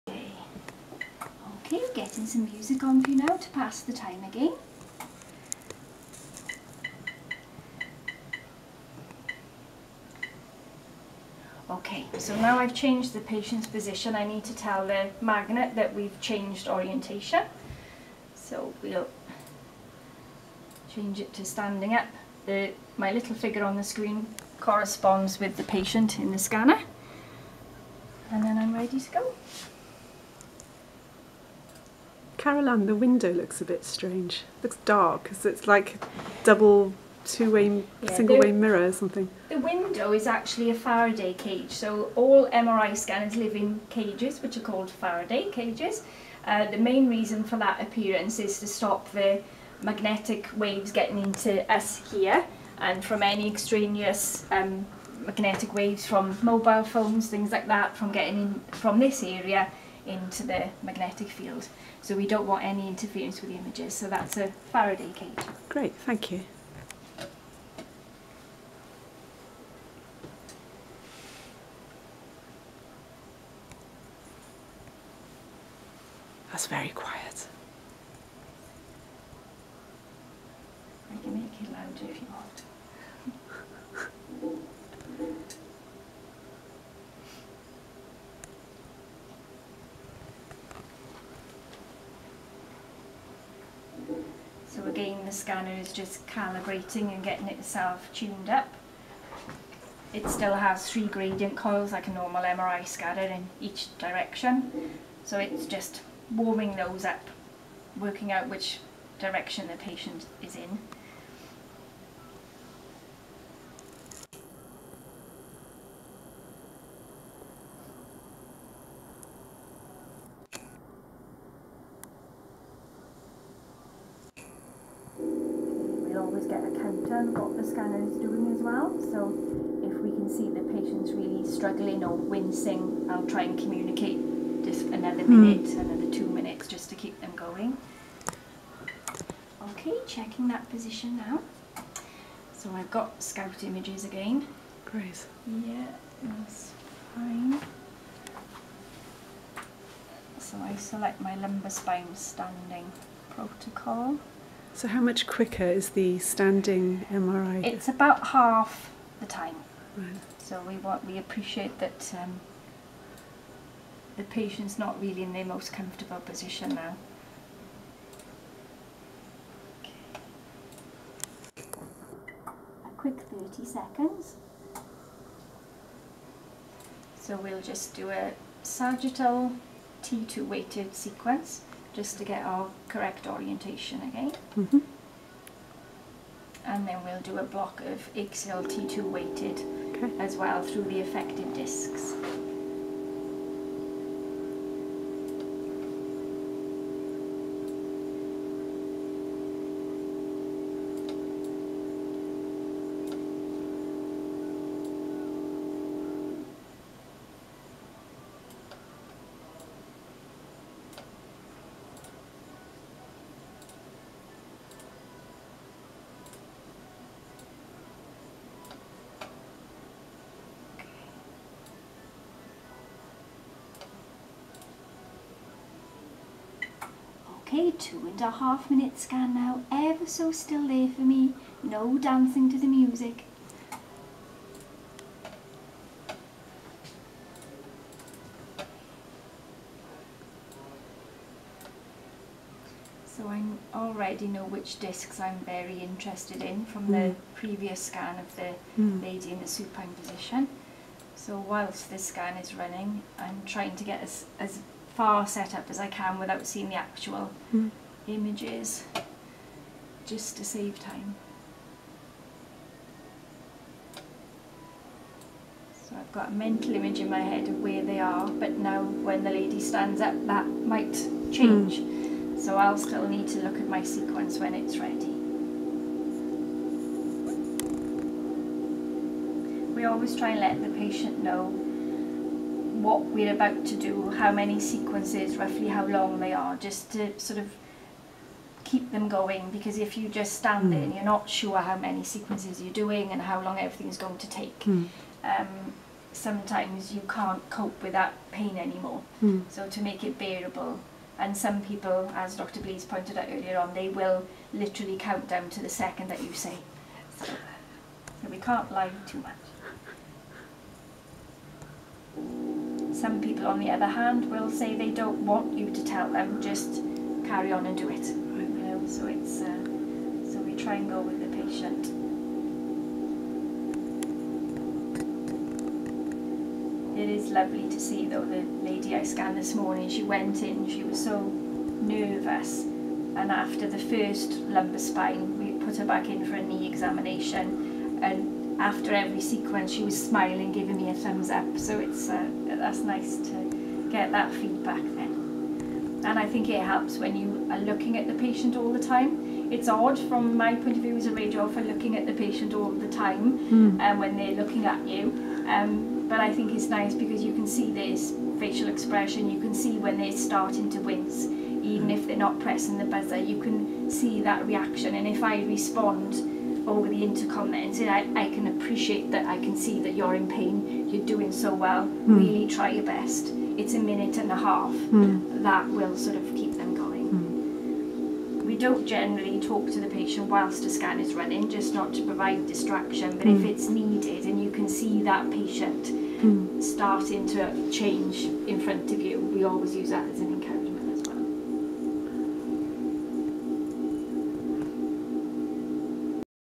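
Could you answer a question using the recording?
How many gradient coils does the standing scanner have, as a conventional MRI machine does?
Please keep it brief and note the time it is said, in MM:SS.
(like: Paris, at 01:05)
3, at 01:40.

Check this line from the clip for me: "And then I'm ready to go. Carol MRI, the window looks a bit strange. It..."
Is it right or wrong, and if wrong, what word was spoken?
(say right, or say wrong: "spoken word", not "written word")
wrong: "Ann", not "MRI".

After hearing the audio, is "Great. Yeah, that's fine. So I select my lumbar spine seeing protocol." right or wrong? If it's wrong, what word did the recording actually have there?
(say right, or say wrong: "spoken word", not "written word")
wrong: "standing", not "seeing".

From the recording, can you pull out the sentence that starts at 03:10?
as well through the affected discs.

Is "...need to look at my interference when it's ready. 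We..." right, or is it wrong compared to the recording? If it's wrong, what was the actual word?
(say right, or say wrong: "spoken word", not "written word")
wrong: "sequence", not "interference".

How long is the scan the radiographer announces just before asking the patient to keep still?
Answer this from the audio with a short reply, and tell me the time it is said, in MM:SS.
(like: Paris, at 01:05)
2 and a half minutes, at 03:47.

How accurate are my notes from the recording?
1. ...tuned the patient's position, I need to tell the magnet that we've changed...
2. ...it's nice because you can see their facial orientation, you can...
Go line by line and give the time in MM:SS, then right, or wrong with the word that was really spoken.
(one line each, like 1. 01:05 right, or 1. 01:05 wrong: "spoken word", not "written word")
1. 00:12 wrong: "changed", not "tuned"
2. 05:56 wrong: "expression", not "orientation".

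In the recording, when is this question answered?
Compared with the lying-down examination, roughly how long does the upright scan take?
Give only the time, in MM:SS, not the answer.
02:38.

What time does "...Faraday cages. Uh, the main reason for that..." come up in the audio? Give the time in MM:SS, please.
00:44.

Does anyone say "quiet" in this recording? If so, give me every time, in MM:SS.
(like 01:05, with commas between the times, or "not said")
01:16.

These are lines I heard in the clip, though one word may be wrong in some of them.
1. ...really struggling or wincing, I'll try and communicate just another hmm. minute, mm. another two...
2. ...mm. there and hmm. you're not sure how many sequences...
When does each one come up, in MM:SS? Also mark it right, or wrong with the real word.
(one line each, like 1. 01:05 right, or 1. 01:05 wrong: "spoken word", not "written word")
1. 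02:11 right
2. 04:50 right.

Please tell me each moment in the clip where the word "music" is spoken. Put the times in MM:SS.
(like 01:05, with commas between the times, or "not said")
00:02, 03:52.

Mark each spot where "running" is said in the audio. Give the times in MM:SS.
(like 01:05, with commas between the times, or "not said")
04:12, 06:21.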